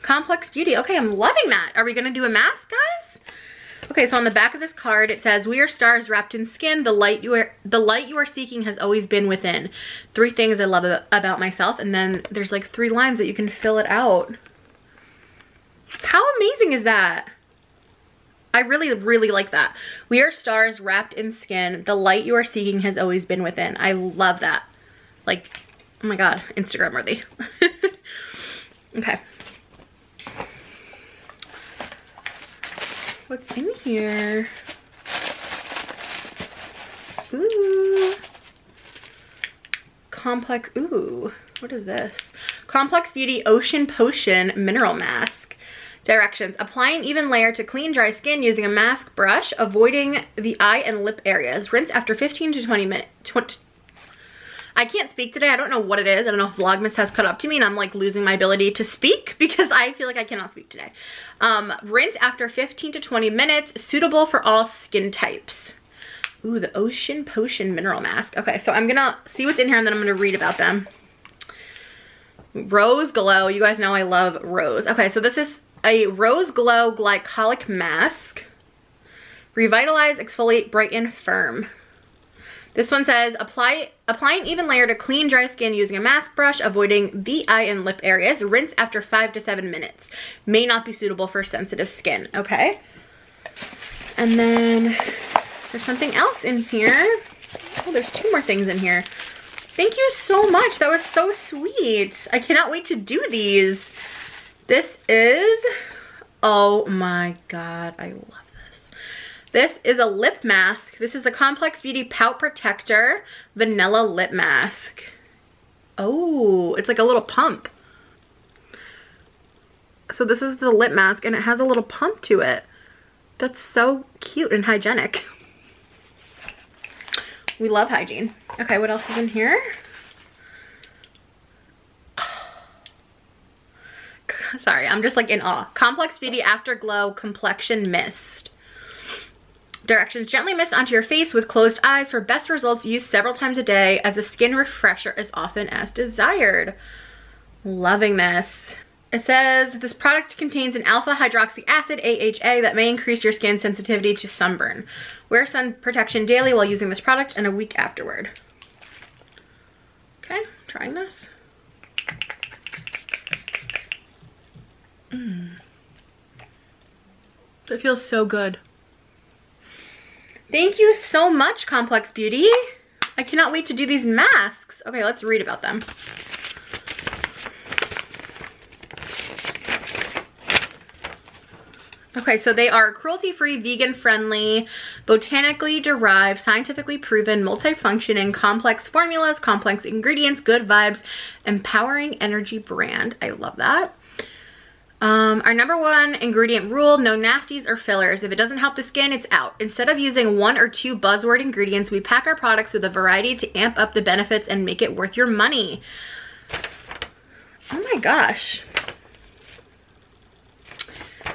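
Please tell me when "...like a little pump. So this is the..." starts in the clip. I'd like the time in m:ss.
1:56.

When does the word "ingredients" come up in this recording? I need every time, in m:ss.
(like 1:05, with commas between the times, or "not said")
3:09, 3:16, 3:21.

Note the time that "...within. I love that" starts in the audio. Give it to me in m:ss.
0:23.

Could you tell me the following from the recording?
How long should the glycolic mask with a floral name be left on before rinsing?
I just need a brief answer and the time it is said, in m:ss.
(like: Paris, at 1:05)
5 to 7 minutes, at 1:29.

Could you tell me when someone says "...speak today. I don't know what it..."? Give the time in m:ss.
0:55.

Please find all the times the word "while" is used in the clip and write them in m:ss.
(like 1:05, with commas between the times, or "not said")
2:36.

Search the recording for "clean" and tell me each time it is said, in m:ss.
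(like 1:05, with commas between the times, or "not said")
0:47, 1:24.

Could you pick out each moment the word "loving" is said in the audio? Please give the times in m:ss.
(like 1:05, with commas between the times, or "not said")
0:01, 2:27.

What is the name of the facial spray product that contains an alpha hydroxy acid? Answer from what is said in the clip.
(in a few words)
Afterglow Complexion Mist.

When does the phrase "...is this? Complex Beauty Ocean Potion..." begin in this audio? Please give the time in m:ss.
0:41.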